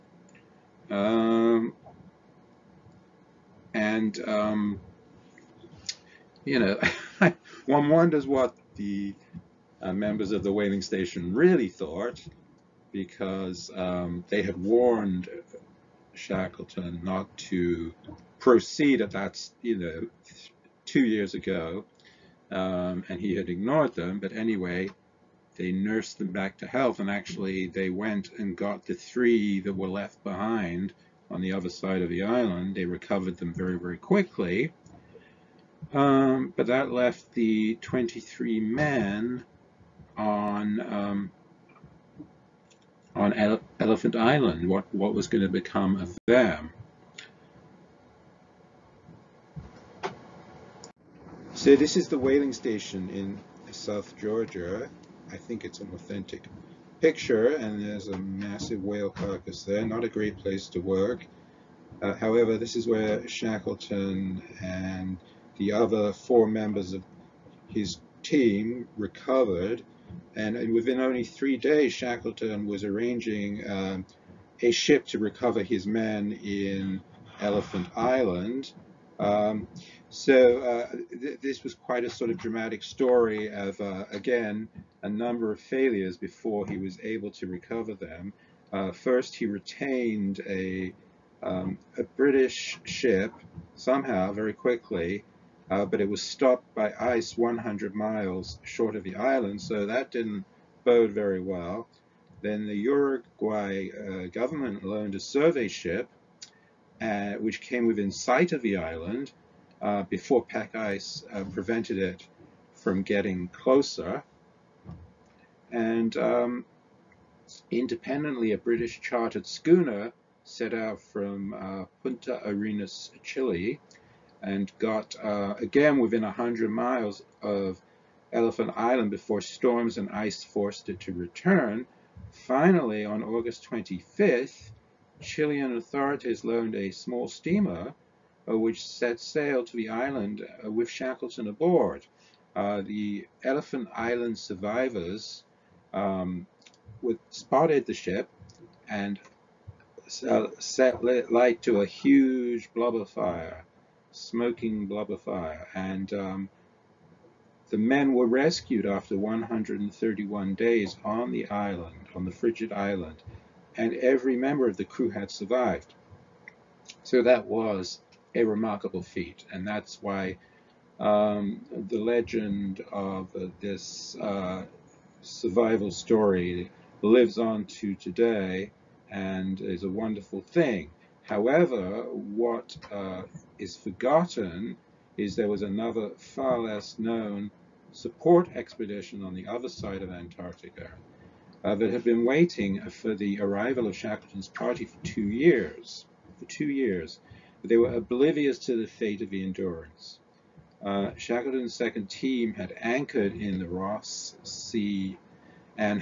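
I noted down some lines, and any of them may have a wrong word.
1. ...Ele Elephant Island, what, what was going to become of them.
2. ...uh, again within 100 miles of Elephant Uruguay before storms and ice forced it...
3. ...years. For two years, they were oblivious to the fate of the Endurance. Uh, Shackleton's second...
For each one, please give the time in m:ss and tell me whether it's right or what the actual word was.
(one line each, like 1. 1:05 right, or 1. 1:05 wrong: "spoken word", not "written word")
1. 0:43 right
2. 2:05 wrong: "Island", not "Uruguay"
3. 3:15 right.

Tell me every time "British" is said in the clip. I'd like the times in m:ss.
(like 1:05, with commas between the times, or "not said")
1:32, 1:58.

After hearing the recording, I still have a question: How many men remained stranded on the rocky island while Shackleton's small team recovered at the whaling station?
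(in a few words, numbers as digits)
23.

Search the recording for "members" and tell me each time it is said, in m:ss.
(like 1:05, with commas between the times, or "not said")
0:09, 1:06, 2:44.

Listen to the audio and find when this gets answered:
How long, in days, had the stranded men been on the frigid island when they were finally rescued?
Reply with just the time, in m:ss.
2:39.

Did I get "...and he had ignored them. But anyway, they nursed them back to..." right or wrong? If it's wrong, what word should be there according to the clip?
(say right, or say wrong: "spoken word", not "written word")
right.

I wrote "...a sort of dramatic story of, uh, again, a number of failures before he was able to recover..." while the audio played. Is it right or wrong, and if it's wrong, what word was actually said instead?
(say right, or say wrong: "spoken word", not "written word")
right.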